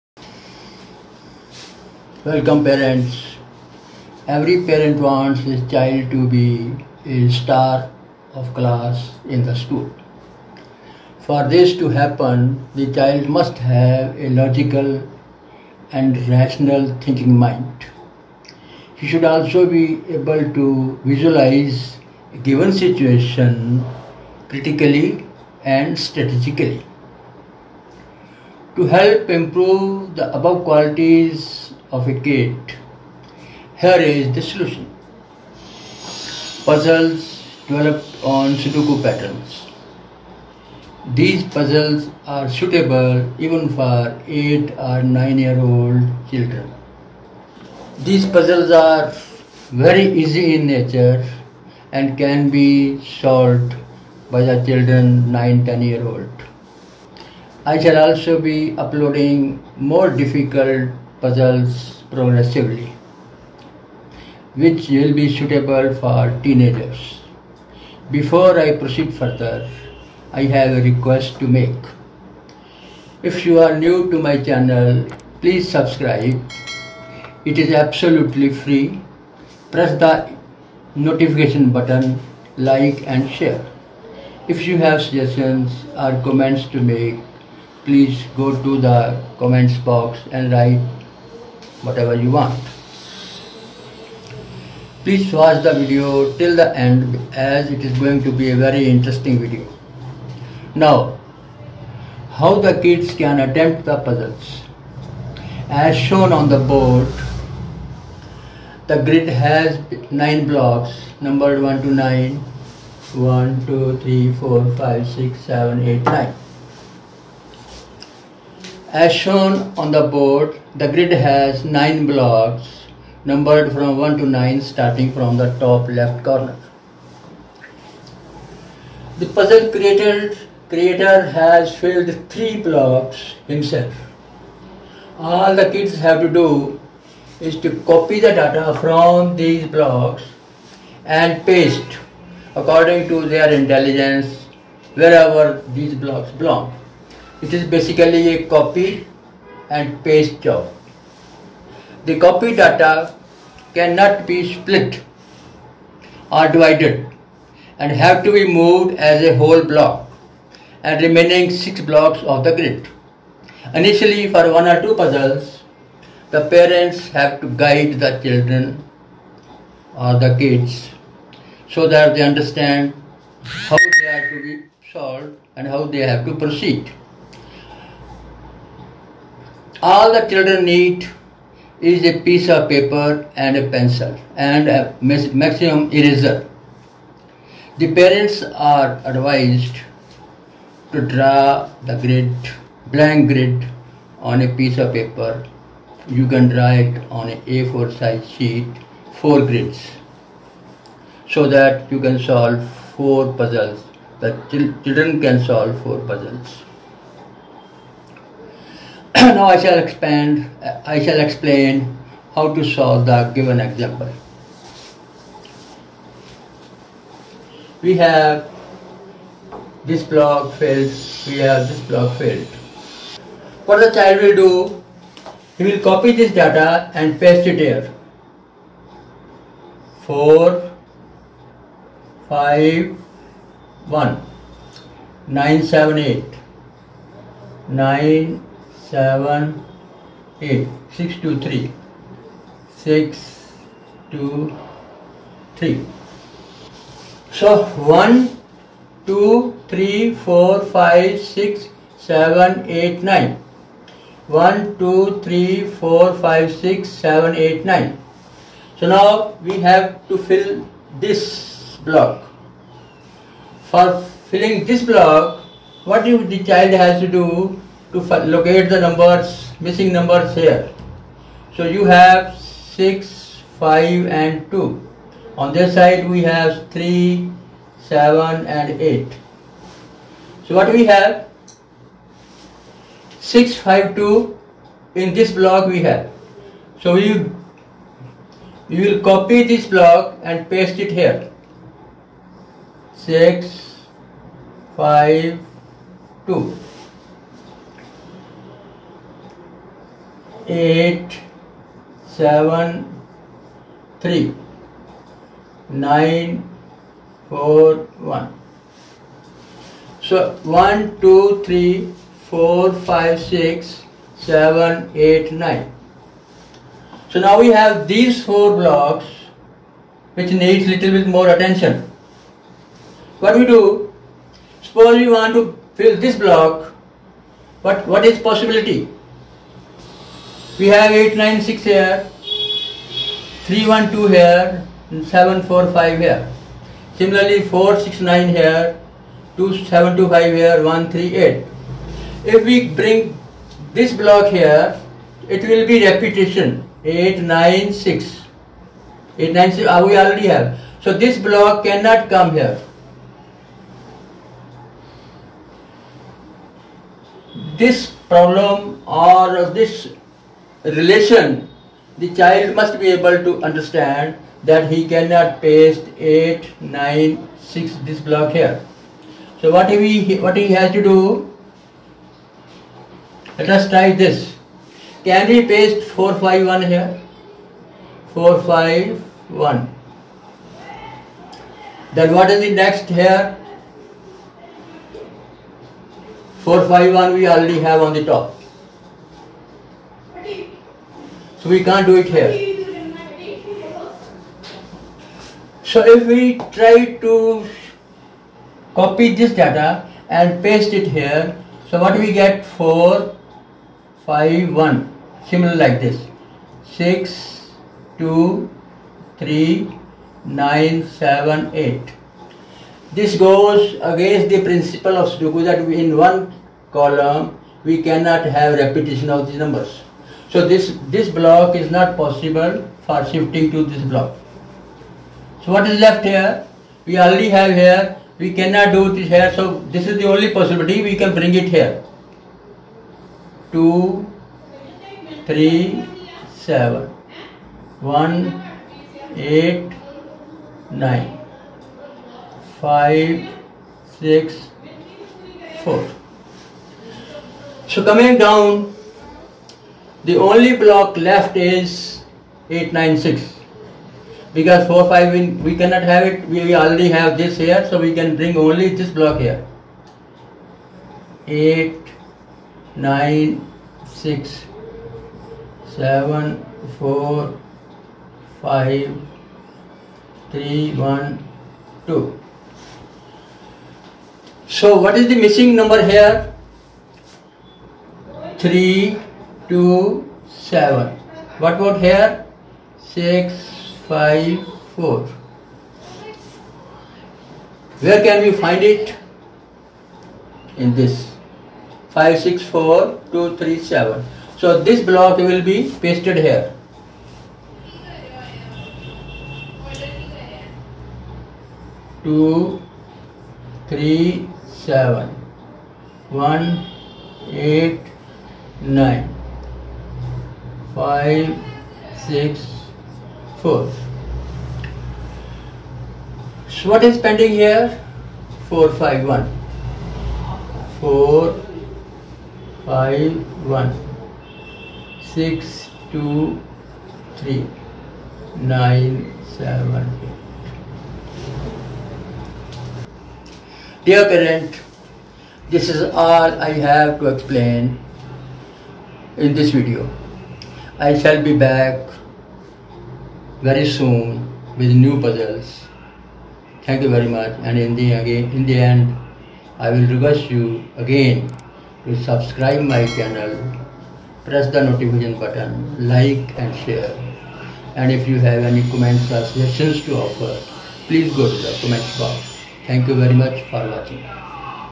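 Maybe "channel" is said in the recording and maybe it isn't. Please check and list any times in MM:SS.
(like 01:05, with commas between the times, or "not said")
01:14, 09:12.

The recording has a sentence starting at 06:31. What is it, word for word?
So we can't do it here.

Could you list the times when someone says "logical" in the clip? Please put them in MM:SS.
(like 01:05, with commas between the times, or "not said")
00:14.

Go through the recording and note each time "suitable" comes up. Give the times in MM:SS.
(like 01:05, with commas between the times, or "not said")
00:42, 01:05.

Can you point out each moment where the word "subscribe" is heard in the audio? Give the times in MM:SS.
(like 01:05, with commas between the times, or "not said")
01:15, 09:12.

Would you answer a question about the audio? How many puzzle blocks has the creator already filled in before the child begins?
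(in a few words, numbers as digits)
3.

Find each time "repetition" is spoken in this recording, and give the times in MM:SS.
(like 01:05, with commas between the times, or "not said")
05:45, 06:58.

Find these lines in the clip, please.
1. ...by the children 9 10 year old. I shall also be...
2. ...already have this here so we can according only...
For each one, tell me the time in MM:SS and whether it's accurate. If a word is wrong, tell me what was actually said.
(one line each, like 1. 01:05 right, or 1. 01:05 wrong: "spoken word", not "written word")
1. 00:54 right
2. 07:36 wrong: "bring", not "according".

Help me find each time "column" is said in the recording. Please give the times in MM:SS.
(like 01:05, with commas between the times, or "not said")
06:56.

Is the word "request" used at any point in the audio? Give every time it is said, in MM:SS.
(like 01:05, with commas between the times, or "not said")
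01:10, 09:09.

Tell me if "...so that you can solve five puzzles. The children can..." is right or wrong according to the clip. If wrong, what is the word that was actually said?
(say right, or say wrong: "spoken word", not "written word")
wrong: "four", not "five".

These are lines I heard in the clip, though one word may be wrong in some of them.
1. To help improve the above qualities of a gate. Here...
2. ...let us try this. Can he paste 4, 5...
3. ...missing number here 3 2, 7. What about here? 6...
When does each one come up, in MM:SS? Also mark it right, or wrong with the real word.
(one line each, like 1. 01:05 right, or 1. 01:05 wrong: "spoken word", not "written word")
1. 00:28 right
2. 06:13 right
3. 07:55 right.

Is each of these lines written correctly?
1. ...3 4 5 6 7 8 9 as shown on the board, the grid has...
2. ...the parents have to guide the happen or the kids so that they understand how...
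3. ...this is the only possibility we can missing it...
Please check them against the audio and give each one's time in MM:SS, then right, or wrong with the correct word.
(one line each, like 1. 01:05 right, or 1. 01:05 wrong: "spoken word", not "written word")
1. 01:54 right
2. 02:46 wrong: "children", not "happen"
3. 07:09 wrong: "bring", not "missing".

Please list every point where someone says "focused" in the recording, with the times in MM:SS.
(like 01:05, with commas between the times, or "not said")
not said.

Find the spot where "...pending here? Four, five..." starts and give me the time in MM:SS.
08:36.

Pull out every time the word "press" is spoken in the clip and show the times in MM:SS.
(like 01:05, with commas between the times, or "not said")
01:19, 09:14.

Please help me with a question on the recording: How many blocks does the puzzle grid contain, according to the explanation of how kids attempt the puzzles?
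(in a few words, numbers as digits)
9.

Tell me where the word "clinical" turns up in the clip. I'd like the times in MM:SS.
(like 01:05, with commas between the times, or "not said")
not said.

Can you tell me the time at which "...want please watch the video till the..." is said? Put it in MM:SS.
01:32.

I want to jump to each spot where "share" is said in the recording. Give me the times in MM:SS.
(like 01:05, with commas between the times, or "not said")
01:23, 09:16.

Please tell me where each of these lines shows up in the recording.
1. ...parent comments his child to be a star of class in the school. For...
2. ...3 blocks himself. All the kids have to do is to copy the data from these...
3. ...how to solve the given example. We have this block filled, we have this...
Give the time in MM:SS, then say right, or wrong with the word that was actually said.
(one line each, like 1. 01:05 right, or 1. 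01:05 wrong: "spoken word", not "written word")
1. 00:04 wrong: "wants", not "comments"
2. 02:12 right
3. 03:32 right.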